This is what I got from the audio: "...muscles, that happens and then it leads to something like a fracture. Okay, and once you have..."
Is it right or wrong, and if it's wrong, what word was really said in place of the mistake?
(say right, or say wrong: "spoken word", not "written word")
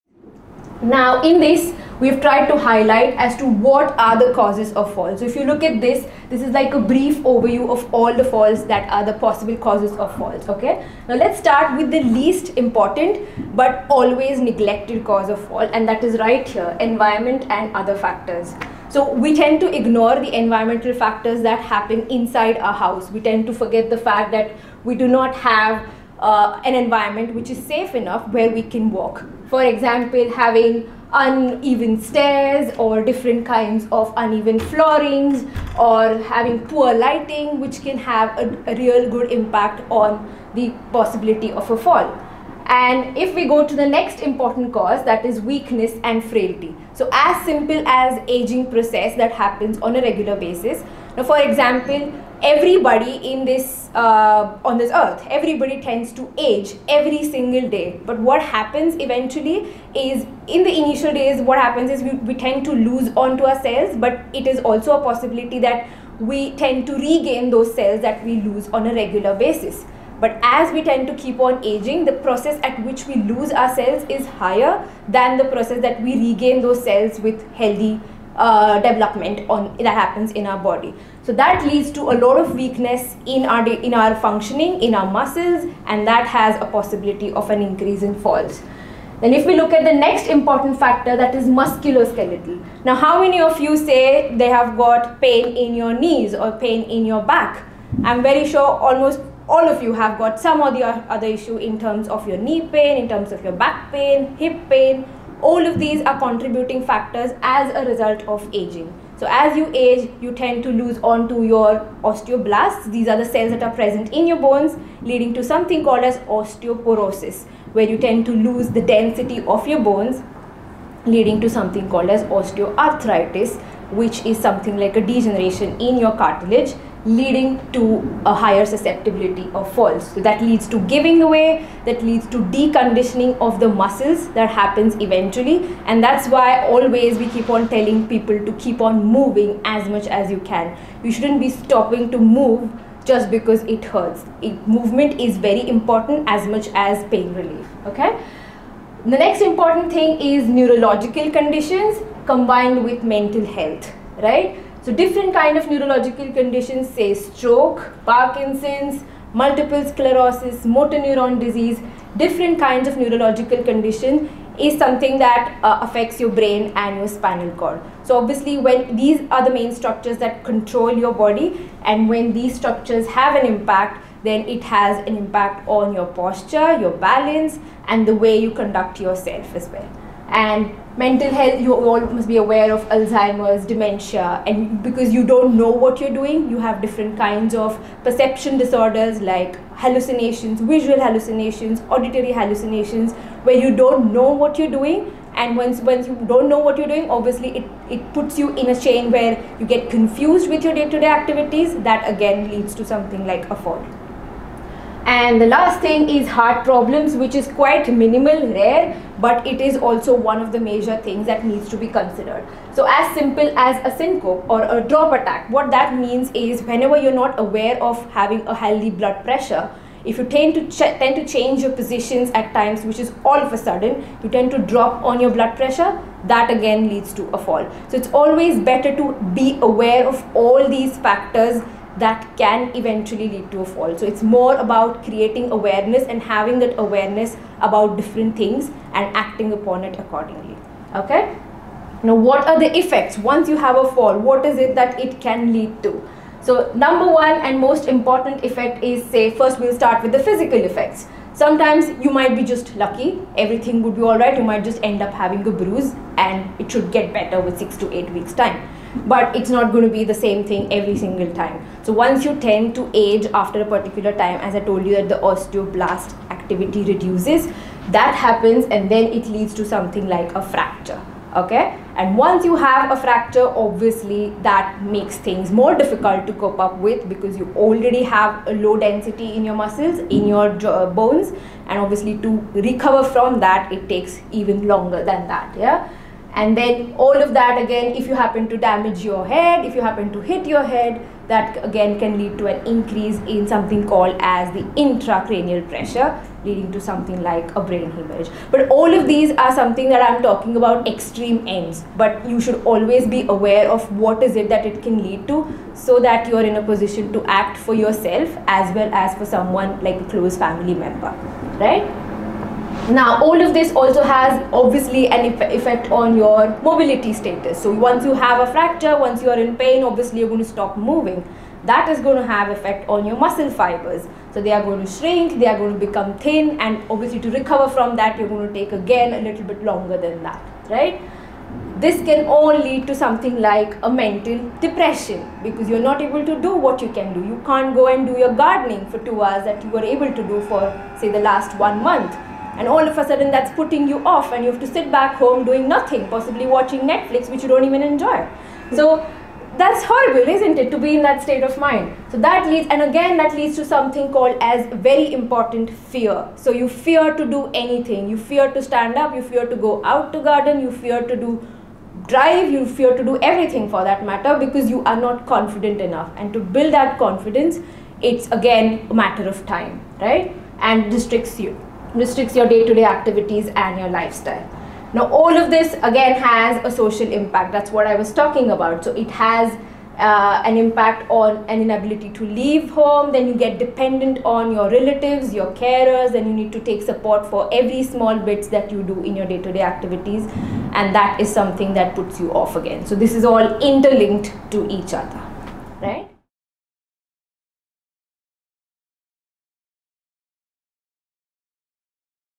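wrong: "reduces", not "muscles".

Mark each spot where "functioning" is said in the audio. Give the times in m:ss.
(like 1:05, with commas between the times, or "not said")
1:24.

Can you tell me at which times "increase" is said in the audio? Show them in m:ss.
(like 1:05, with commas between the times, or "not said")
1:27, 4:52.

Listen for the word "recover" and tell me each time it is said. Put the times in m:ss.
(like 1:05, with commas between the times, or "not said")
4:42, 5:27.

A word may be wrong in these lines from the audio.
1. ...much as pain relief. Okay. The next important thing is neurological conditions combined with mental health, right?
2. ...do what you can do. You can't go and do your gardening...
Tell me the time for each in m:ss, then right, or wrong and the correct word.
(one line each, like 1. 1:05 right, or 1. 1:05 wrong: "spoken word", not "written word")
1. 2:26 right
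2. 5:36 right.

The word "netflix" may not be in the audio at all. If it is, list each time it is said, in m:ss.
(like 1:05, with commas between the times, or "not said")
5:46.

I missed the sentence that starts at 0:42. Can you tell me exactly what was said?
And if we go to the next important cause, that is weakness and frailty.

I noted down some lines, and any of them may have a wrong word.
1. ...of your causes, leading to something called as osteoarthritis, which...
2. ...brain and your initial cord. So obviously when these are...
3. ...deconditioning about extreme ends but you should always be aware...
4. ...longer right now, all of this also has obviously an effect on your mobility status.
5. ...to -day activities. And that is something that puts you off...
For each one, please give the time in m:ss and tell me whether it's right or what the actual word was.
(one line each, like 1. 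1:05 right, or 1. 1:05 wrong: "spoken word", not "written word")
1. 1:59 wrong: "bones", not "causes"
2. 2:46 wrong: "spinal", not "initial"
3. 5:00 wrong: "talking", not "deconditioning"
4. 5:10 wrong: "member", not "longer"
5. 6:29 right.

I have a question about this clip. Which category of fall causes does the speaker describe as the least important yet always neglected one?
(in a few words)
Environment and other factors.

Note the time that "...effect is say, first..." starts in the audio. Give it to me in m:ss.
4:08.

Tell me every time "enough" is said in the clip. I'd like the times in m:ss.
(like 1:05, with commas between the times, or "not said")
0:27, 6:05.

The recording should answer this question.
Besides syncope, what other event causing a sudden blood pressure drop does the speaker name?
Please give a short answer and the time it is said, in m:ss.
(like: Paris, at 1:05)
Drop attack, at 3:34.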